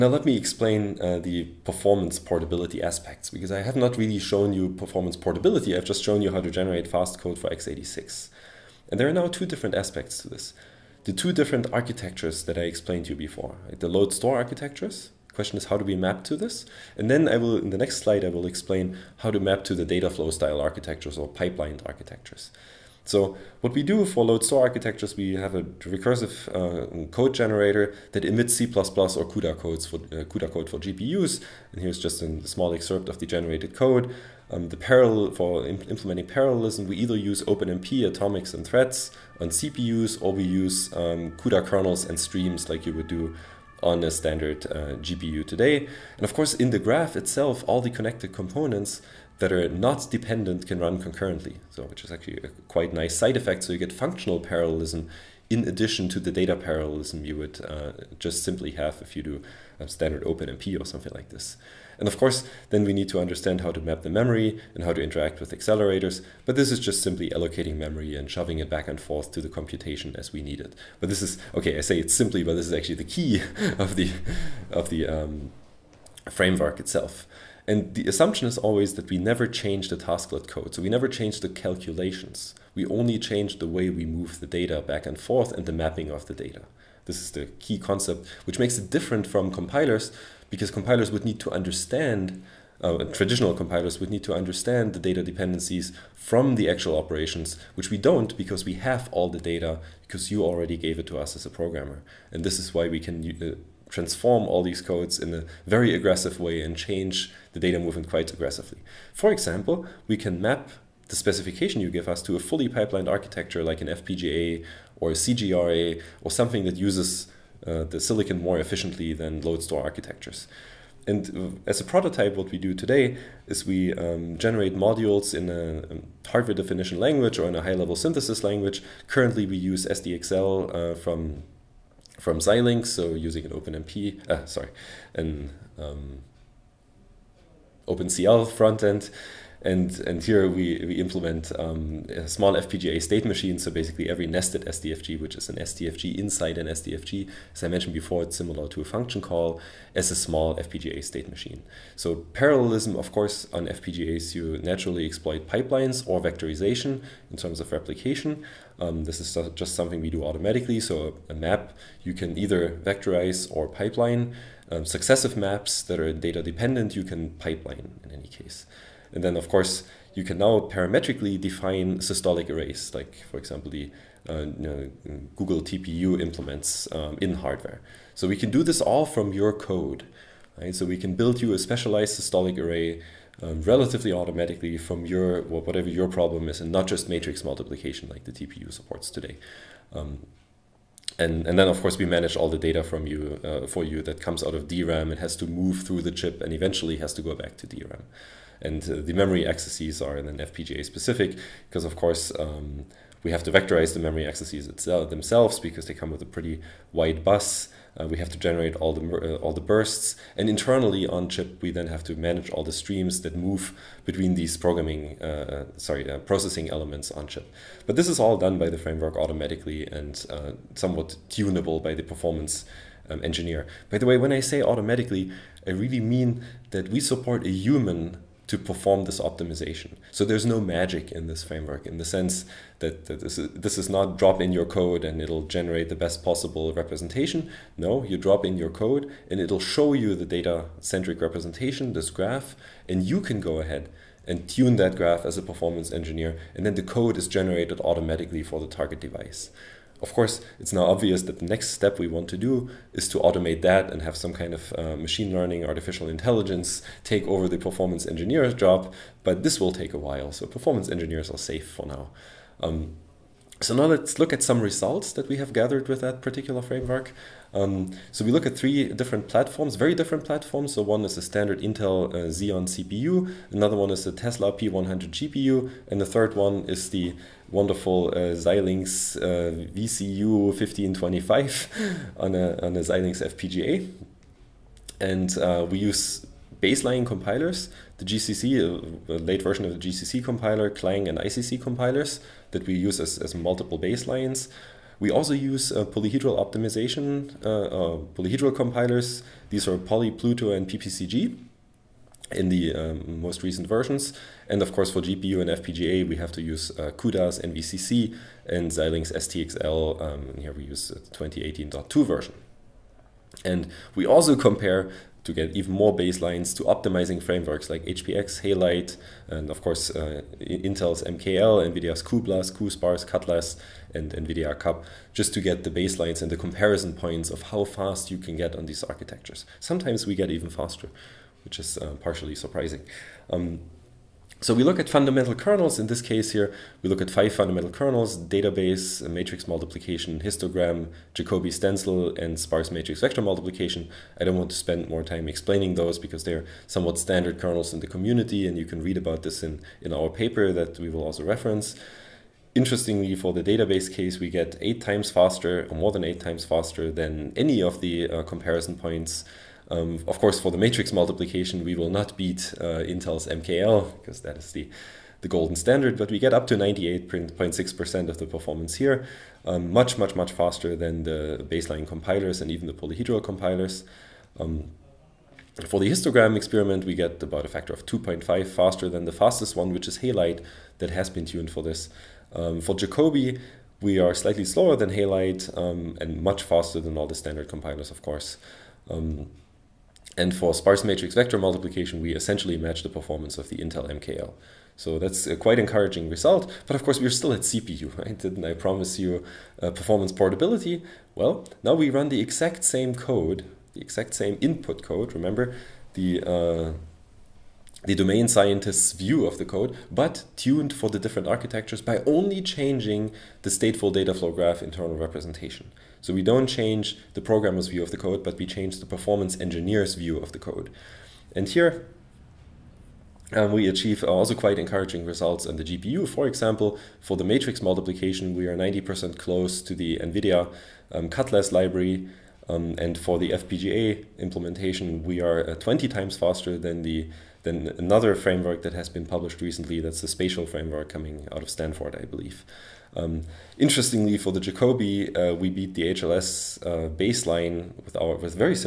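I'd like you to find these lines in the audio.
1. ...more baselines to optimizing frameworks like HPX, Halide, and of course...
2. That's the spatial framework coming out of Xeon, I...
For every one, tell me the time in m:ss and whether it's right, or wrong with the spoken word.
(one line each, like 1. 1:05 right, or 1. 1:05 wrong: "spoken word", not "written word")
1. 5:15 right
2. 7:19 wrong: "Stanford", not "Xeon".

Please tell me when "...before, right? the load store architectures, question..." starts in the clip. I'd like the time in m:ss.
0:13.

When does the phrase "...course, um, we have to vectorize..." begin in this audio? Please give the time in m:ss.
3:21.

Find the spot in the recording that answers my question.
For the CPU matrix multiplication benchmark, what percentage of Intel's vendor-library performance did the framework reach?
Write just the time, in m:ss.
6:06.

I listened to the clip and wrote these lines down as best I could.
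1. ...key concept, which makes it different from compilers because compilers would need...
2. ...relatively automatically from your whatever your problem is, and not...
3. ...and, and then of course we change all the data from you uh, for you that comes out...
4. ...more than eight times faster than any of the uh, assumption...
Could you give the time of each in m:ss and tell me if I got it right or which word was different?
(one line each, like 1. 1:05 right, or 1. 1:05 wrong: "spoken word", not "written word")
1. 1:27 right
2. 3:03 right
3. 3:11 wrong: "manage", not "change"
4. 5:55 wrong: "comparison", not "assumption".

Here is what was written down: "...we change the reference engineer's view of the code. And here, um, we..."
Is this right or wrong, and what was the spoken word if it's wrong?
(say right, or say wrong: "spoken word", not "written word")
wrong: "performance", not "reference".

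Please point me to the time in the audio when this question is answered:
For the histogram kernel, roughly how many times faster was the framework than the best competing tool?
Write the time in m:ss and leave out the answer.
6:17.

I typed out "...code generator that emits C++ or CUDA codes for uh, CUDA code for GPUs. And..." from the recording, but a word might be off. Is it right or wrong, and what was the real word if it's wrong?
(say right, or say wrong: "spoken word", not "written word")
right.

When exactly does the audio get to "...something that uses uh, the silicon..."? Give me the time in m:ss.
1:56.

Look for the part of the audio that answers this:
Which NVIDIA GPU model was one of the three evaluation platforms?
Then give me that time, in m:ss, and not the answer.
4:34.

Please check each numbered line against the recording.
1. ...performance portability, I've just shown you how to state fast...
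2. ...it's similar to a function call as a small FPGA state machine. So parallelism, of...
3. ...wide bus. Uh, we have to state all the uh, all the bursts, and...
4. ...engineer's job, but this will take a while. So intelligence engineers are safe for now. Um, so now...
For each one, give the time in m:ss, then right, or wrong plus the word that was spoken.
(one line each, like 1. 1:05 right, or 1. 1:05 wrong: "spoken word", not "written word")
1. 0:04 wrong: "generate", not "state"
2. 2:28 right
3. 3:26 wrong: "generate", not "state"
4. 4:18 wrong: "performance", not "intelligence".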